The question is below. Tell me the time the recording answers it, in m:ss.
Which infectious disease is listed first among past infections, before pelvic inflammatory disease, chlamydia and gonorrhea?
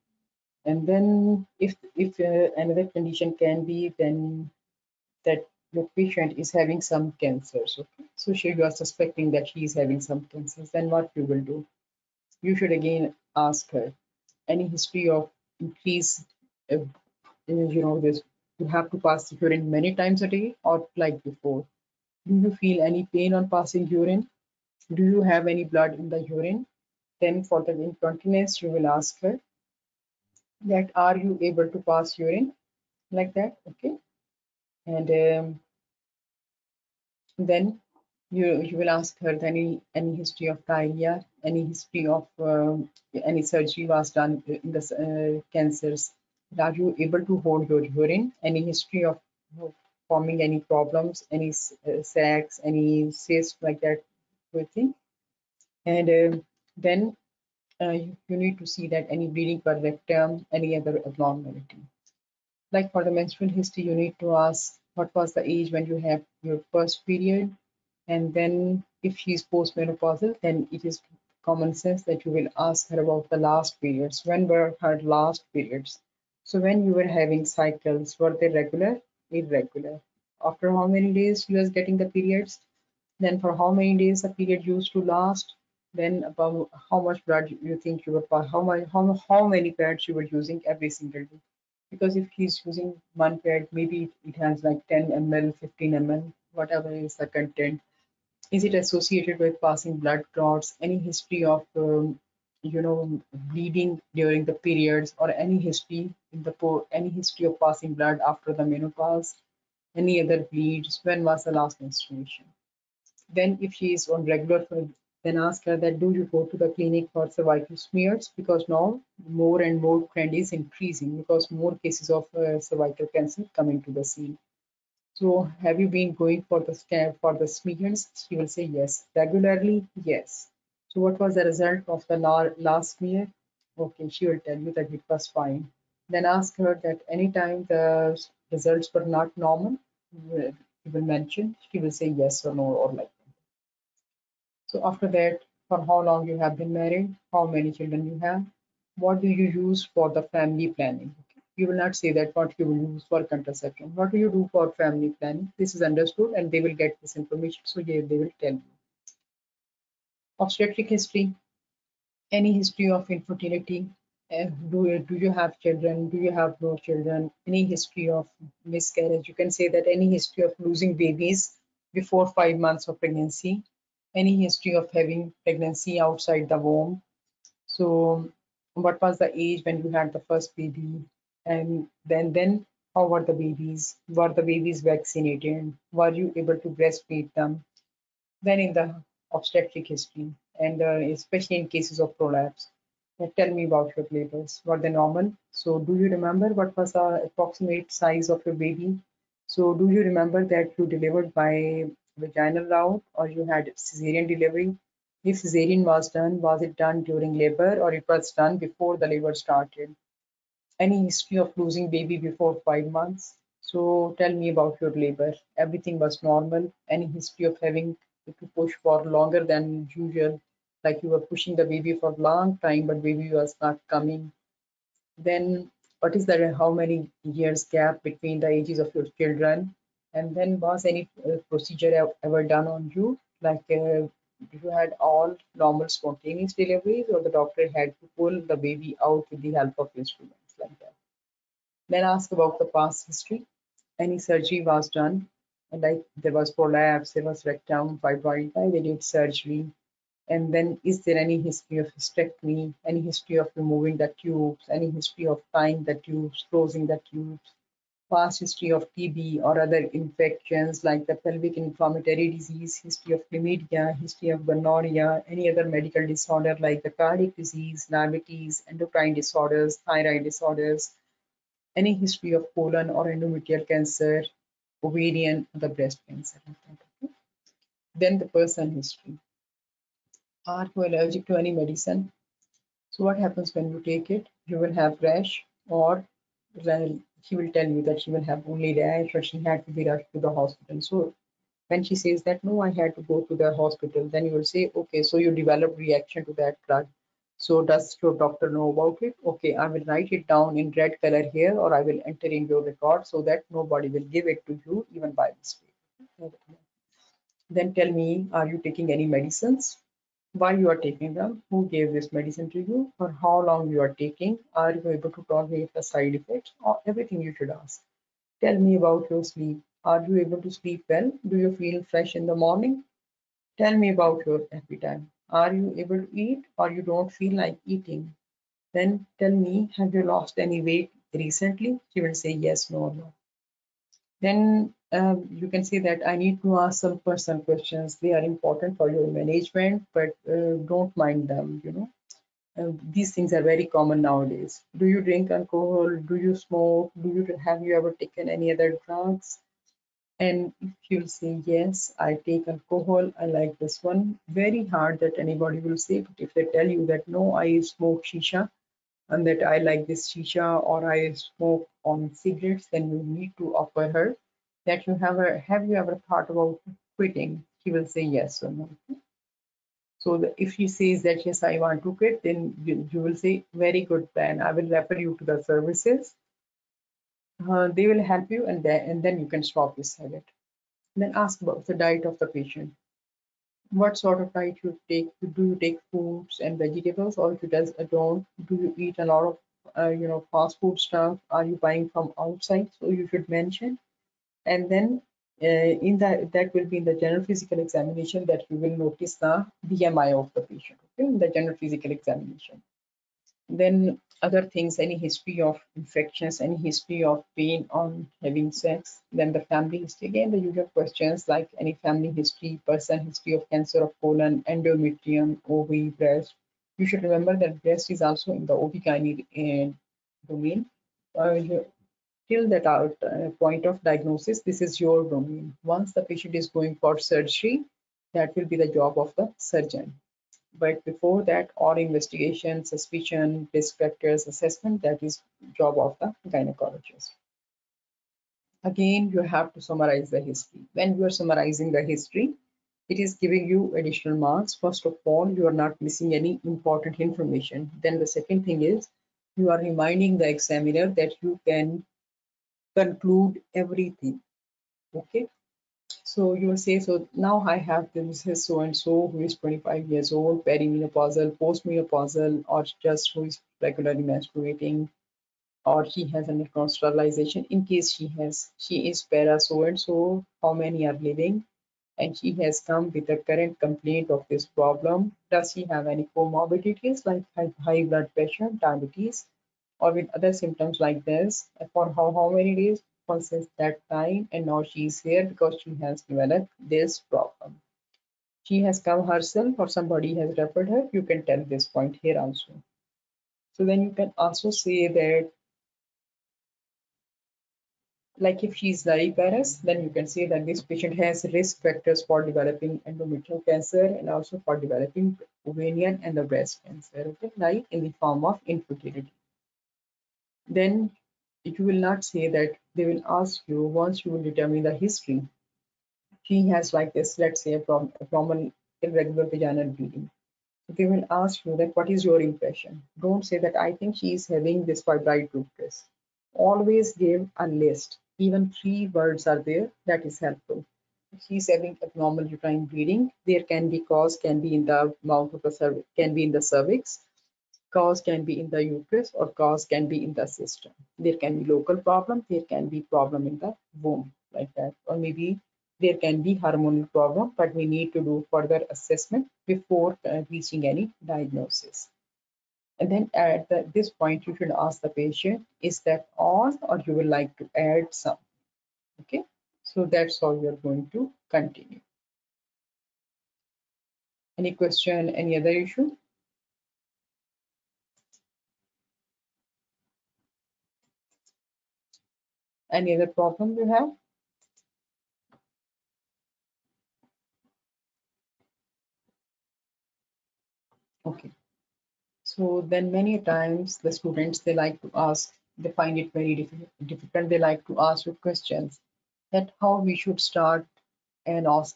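4:18.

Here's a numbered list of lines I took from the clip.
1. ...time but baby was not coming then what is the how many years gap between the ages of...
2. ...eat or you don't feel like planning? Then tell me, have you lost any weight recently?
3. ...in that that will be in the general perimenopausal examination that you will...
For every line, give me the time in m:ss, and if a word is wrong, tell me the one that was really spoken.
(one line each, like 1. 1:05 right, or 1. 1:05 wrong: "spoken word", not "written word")
1. 3:42 right
2. 5:26 wrong: "eating", not "planning"
3. 6:35 wrong: "physical", not "perimenopausal".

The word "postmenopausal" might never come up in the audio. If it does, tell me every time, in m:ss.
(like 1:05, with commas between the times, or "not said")
1:09, 7:41.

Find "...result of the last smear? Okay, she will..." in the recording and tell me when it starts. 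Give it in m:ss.
2:11.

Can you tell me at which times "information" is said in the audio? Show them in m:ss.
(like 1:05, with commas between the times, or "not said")
2:37, 7:27.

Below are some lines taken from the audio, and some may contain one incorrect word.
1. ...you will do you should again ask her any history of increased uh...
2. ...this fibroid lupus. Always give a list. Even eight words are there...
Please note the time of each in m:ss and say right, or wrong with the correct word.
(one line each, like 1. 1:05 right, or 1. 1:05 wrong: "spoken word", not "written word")
1. 0:11 right
2. 8:44 wrong: "three", not "eight".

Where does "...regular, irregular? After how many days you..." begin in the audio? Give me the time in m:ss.
1:18.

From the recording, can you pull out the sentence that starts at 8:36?
She has like this, let's say a, prom a common irregular vaginal bleeding.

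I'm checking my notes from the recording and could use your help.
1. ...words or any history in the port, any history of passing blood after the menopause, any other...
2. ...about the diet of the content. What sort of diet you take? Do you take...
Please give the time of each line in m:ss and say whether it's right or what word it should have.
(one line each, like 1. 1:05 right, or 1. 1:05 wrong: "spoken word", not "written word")
1. 1:44 wrong: "periods", not "words"
2. 6:21 wrong: "patient", not "content".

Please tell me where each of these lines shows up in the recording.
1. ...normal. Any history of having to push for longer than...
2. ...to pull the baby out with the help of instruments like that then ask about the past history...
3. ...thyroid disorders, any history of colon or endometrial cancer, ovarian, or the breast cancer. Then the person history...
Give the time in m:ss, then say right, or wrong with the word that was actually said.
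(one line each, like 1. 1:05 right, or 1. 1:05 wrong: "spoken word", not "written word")
1. 3:36 right
2. 3:58 right
3. 4:29 right.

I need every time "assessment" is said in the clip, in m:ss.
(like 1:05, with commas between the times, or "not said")
7:14, 9:08.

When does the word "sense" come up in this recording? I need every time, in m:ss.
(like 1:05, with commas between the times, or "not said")
1:11.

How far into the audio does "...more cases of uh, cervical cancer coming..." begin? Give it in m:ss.
2:01.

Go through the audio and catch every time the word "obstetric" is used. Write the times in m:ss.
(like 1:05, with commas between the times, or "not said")
2:40, 3:09.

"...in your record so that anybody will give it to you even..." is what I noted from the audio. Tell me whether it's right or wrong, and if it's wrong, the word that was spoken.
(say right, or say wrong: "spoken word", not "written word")
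wrong: "nobody", not "anybody".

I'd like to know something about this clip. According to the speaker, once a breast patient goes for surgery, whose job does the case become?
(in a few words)
the surgeon.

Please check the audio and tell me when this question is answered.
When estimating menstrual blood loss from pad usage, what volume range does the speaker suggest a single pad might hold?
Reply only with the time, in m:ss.
1:34.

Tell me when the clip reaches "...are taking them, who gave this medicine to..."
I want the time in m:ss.
5:10.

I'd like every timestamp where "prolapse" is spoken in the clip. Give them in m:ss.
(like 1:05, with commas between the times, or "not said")
3:12, 4:06.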